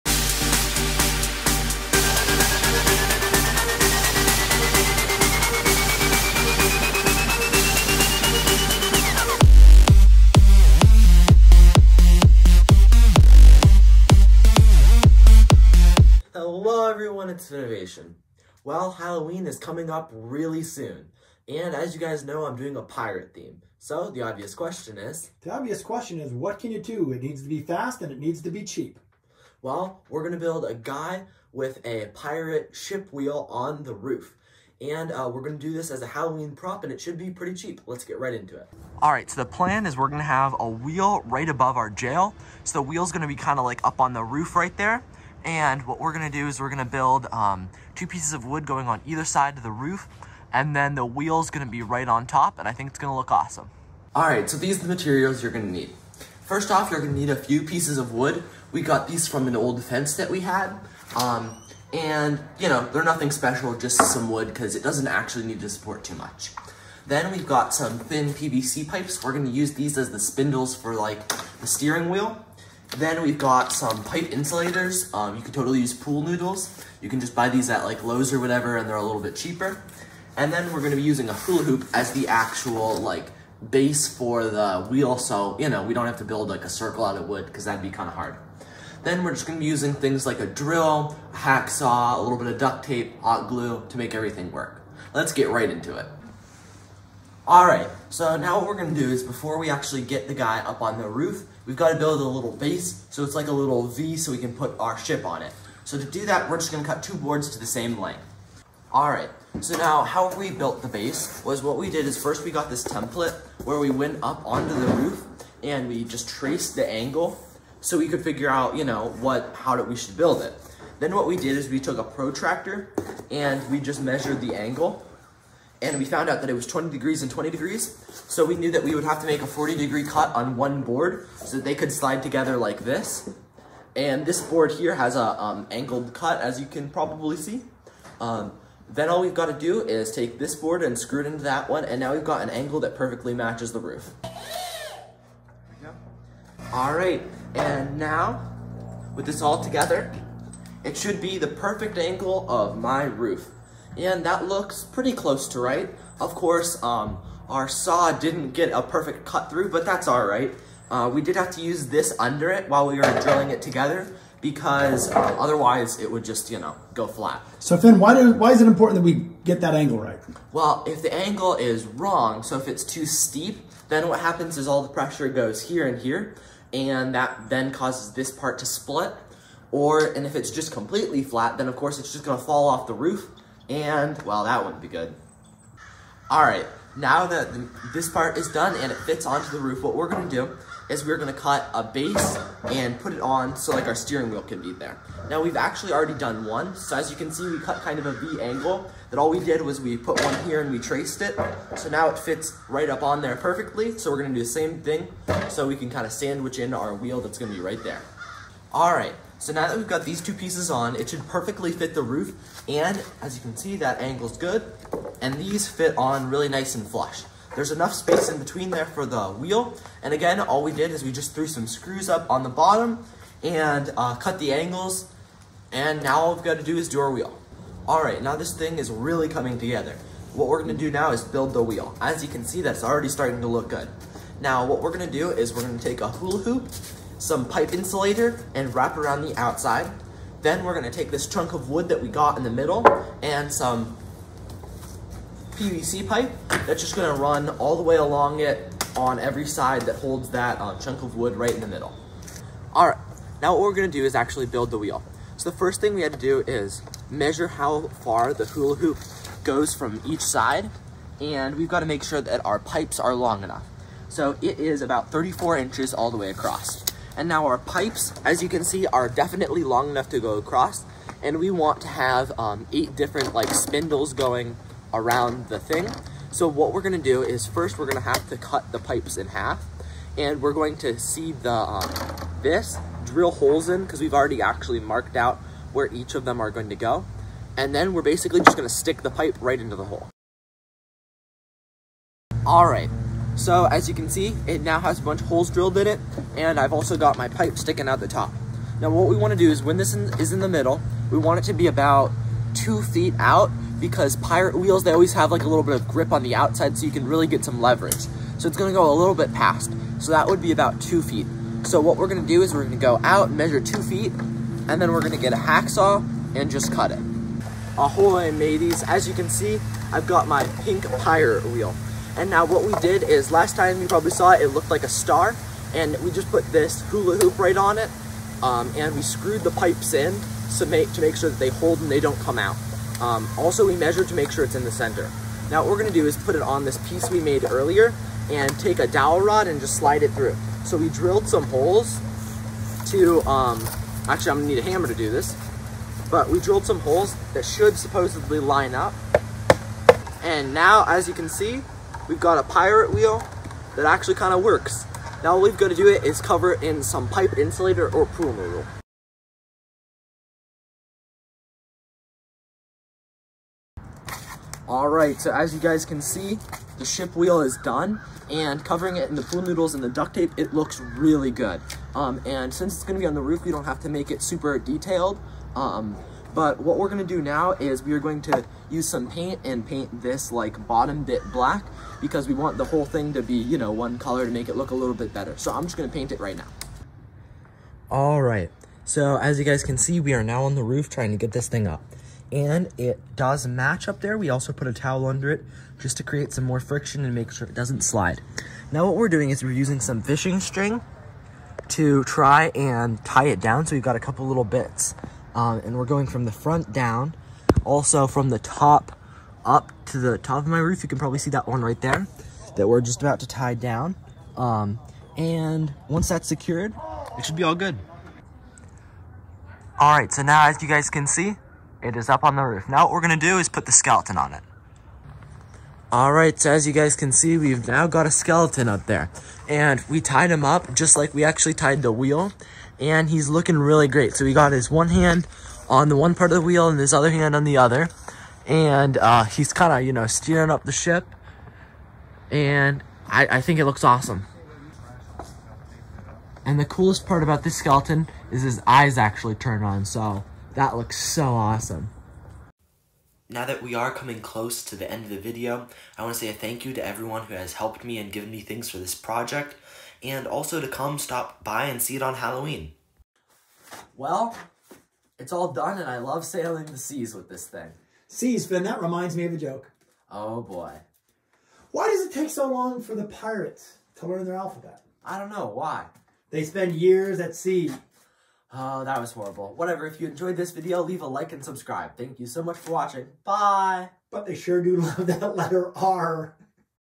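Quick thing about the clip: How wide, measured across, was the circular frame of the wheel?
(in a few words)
34 inches.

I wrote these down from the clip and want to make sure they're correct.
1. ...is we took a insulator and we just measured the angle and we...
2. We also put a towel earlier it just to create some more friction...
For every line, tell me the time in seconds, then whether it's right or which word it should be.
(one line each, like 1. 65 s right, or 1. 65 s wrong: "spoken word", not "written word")
1. 121 s wrong: "protractor", not "insulator"
2. 394 s wrong: "under", not "earlier".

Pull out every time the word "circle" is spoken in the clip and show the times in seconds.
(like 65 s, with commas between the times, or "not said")
86 s.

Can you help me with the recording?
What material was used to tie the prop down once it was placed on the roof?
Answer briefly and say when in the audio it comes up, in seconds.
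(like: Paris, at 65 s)
fishing string, at 400 s.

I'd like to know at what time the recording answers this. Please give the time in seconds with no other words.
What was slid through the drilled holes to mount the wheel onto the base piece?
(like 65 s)
338 s.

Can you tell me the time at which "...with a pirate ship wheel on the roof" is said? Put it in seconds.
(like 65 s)
31 s.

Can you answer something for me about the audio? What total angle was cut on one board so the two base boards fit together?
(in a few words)
40 degrees.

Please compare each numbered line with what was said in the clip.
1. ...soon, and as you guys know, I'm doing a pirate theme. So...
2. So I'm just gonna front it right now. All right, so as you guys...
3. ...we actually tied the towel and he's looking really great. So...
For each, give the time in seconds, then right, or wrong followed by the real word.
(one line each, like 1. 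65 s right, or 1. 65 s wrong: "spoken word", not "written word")
1. 20 s right
2. 385 s wrong: "paint", not "front"
3. 431 s wrong: "wheel", not "towel".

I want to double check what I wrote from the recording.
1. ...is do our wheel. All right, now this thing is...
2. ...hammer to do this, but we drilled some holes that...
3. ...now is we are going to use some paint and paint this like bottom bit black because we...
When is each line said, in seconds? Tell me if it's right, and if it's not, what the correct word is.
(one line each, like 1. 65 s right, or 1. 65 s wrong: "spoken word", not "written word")
1. 226 s right
2. 344 s right
3. 377 s right.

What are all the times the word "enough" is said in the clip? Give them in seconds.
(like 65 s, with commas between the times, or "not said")
217 s, 263 s, 269 s.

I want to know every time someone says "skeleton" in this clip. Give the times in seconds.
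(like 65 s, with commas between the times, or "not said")
423 s, 428 s, 447 s.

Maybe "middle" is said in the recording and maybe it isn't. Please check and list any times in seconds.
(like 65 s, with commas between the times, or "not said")
242 s, 251 s, 300 s.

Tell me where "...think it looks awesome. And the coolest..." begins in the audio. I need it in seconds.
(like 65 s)
443 s.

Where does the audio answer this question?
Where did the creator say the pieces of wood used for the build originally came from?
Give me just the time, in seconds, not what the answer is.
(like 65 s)
59 s.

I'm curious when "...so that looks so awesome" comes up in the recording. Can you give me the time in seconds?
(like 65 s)
449 s.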